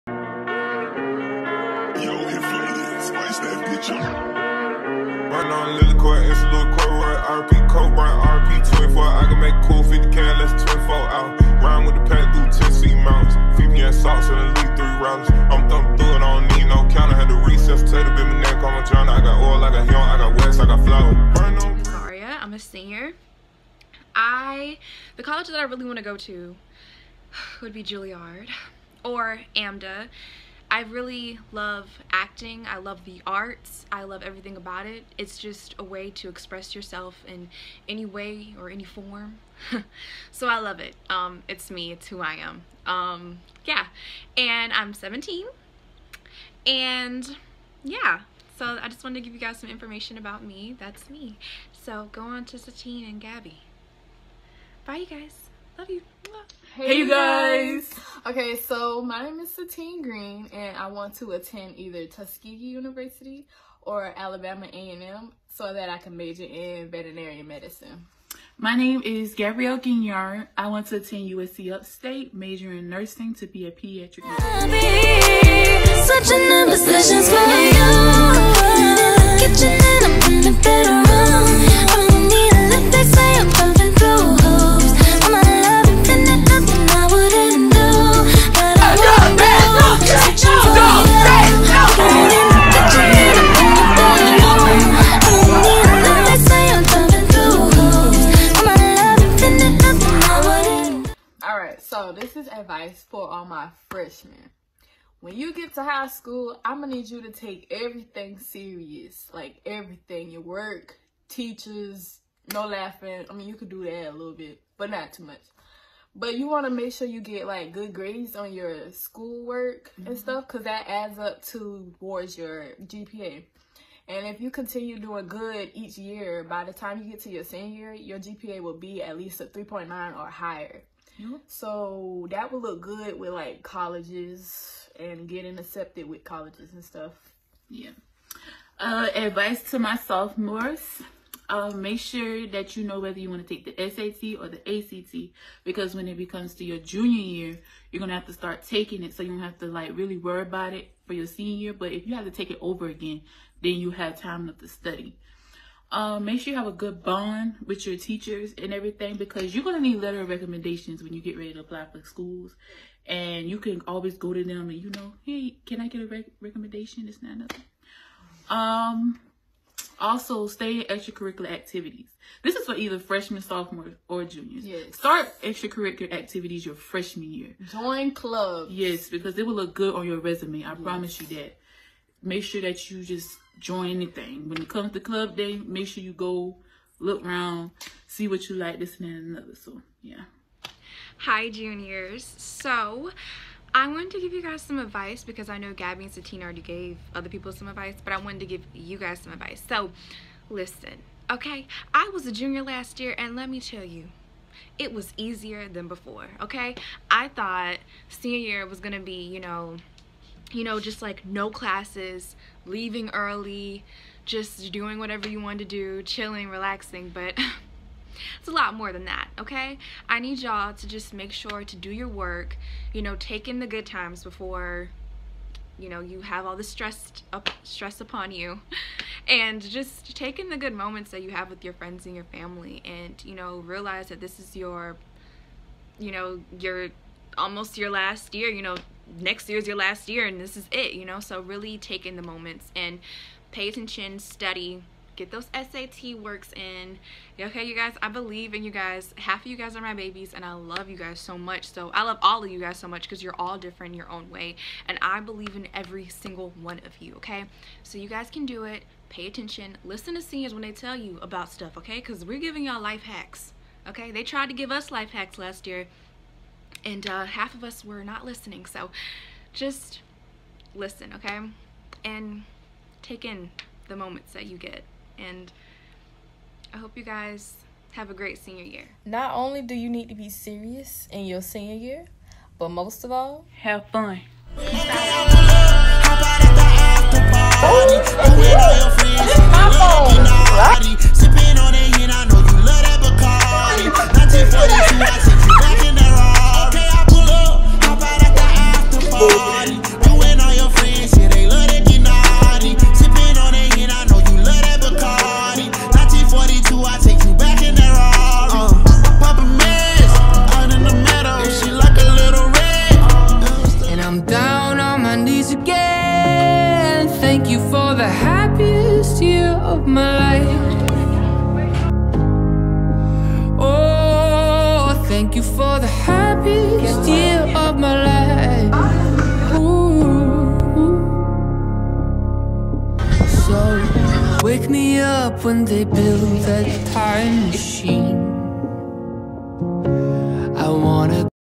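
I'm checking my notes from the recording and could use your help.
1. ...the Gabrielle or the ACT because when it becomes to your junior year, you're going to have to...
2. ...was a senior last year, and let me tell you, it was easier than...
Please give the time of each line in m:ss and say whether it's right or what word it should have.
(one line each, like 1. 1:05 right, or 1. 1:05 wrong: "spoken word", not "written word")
1. 2:23 wrong: "SAT", not "Gabrielle"
2. 3:22 wrong: "junior", not "senior".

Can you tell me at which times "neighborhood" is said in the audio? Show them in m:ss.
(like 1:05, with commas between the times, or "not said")
not said.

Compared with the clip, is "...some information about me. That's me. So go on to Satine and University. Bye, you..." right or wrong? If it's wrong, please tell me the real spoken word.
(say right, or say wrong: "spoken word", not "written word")
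wrong: "Gabby", not "University".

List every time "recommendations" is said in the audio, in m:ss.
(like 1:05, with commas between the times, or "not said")
2:40, 2:46.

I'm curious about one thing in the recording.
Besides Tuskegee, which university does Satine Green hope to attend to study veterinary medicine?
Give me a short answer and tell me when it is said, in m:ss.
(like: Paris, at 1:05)
Alabama A&M, at 1:04.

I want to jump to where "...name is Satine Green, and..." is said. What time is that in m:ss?
0:59.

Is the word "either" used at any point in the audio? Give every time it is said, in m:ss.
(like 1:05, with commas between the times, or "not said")
1:01, 2:52.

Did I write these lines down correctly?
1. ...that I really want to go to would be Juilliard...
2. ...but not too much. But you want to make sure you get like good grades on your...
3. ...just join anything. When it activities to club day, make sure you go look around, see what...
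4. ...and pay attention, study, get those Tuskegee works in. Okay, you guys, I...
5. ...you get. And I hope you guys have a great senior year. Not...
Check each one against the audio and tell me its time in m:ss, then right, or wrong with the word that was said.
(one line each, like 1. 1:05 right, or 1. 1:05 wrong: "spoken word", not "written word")
1. 0:25 right
2. 1:54 right
3. 3:03 wrong: "comes", not "activities"
4. 4:02 wrong: "SAT", not "Tuskegee"
5. 4:34 right.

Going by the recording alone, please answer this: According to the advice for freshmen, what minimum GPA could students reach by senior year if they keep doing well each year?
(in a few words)
3.9.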